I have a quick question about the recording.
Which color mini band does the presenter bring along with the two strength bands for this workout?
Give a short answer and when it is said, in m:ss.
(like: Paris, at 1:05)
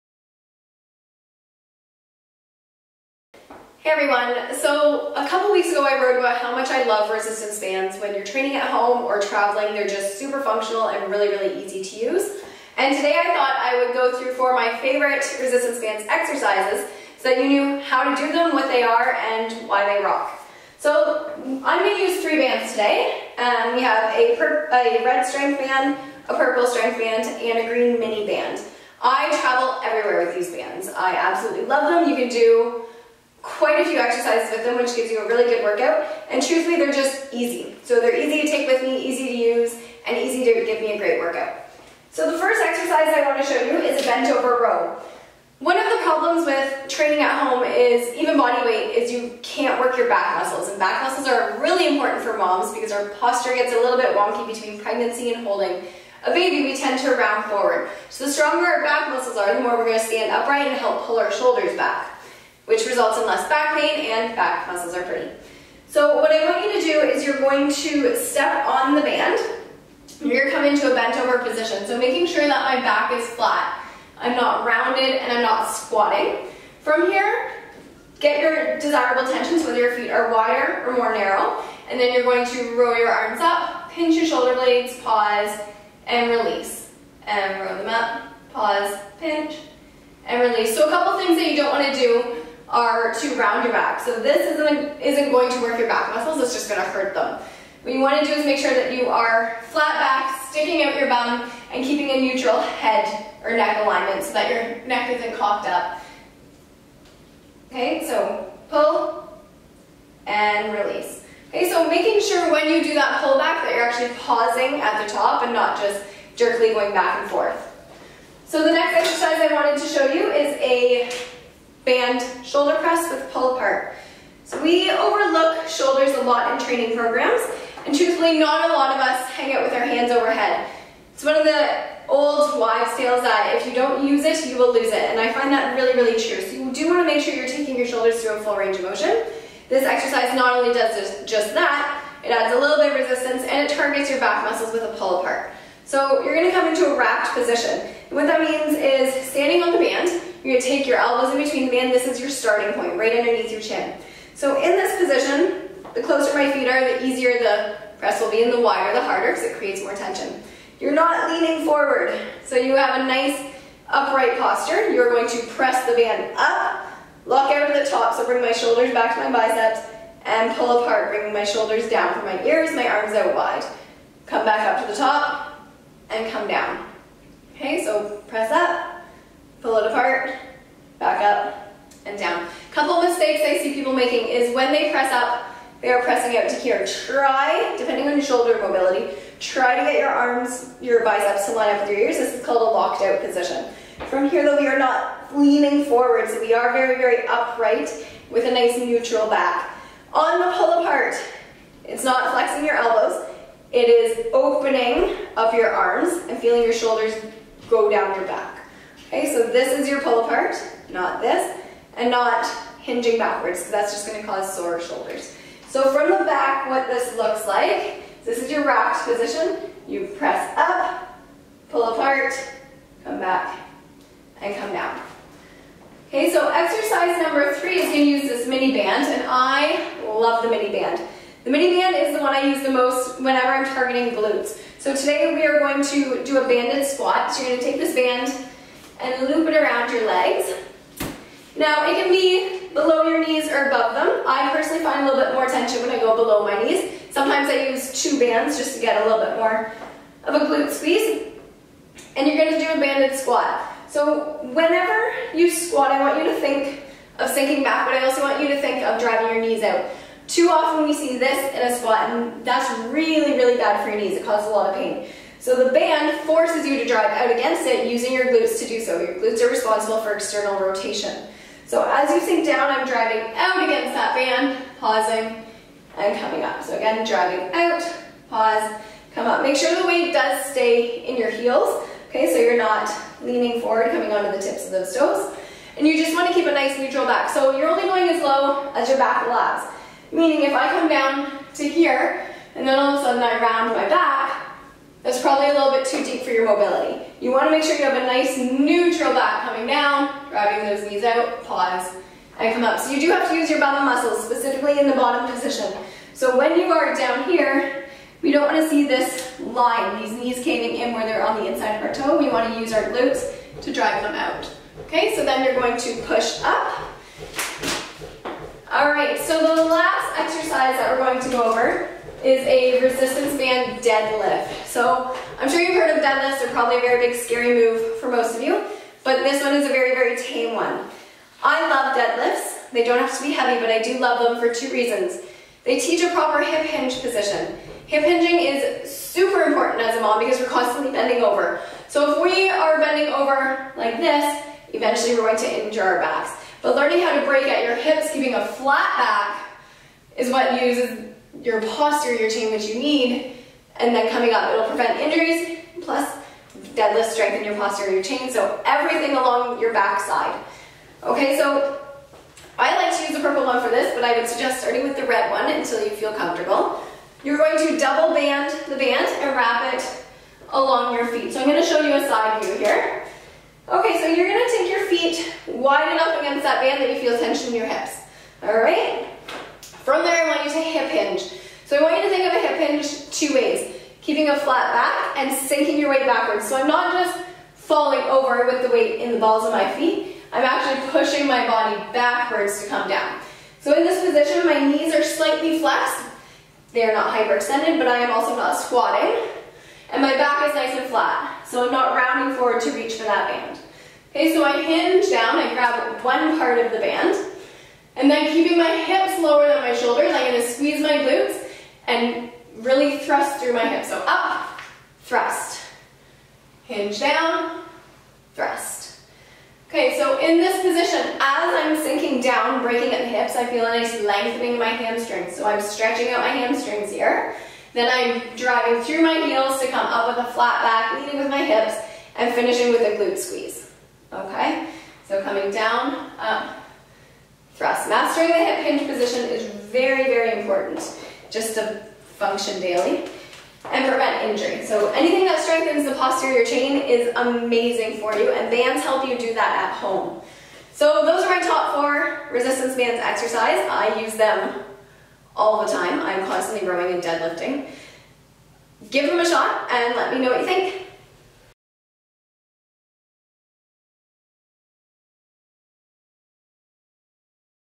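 green, at 0:27.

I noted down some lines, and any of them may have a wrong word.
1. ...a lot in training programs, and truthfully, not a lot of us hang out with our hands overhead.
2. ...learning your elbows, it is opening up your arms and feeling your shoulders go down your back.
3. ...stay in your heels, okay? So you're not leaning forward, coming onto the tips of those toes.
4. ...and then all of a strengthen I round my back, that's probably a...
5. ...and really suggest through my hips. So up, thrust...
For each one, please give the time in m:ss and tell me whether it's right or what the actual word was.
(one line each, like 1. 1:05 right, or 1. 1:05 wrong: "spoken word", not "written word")
1. 2:06 right
2. 3:22 wrong: "flexing", not "learning"
3. 4:40 right
4. 4:52 wrong: "sudden", not "strengthen"
5. 6:51 wrong: "thrust", not "suggest".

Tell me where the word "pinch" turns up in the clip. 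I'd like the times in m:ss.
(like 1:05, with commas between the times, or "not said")
1:23, 1:29.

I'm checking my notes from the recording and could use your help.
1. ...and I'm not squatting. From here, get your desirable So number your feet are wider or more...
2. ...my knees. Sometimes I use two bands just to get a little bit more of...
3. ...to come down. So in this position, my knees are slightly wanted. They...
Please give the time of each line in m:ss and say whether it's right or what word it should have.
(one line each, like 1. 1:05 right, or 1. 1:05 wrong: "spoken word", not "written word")
1. 1:15 wrong: "whether", not "number"
2. 4:06 right
3. 6:32 wrong: "flexed", not "wanted".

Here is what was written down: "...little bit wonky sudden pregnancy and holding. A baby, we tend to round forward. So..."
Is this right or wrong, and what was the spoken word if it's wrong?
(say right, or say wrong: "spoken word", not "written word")
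wrong: "between", not "sudden".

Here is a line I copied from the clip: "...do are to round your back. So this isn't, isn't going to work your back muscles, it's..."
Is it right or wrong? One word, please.
right.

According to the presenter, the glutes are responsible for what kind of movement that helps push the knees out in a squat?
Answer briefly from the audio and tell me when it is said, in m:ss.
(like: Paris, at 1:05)
external rotation, at 4:30.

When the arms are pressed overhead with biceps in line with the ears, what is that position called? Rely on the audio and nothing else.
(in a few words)
locked out position.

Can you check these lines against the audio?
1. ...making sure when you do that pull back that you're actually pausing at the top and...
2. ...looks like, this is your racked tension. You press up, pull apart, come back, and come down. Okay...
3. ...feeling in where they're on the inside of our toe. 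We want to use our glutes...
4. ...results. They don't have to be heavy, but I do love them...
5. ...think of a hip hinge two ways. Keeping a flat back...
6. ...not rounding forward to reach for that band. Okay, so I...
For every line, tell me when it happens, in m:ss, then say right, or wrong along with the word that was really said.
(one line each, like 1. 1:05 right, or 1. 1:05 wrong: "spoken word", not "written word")
1. 1:51 right
2. 3:37 wrong: "position", not "tension"
3. 5:10 wrong: "caving", not "feeling"
4. 5:31 wrong: "deadlifts", not "results"
5. 6:22 right
6. 6:41 right.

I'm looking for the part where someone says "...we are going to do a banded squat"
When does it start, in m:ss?
3:55.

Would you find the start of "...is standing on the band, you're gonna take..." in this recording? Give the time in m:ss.
2:28.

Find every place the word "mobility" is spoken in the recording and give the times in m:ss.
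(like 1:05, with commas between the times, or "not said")
3:08, 4:56.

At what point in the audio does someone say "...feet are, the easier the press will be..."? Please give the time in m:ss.
2:36.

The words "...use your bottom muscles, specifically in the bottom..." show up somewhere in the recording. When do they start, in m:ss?
5:03.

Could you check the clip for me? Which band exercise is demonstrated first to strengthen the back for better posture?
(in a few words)
bent over row.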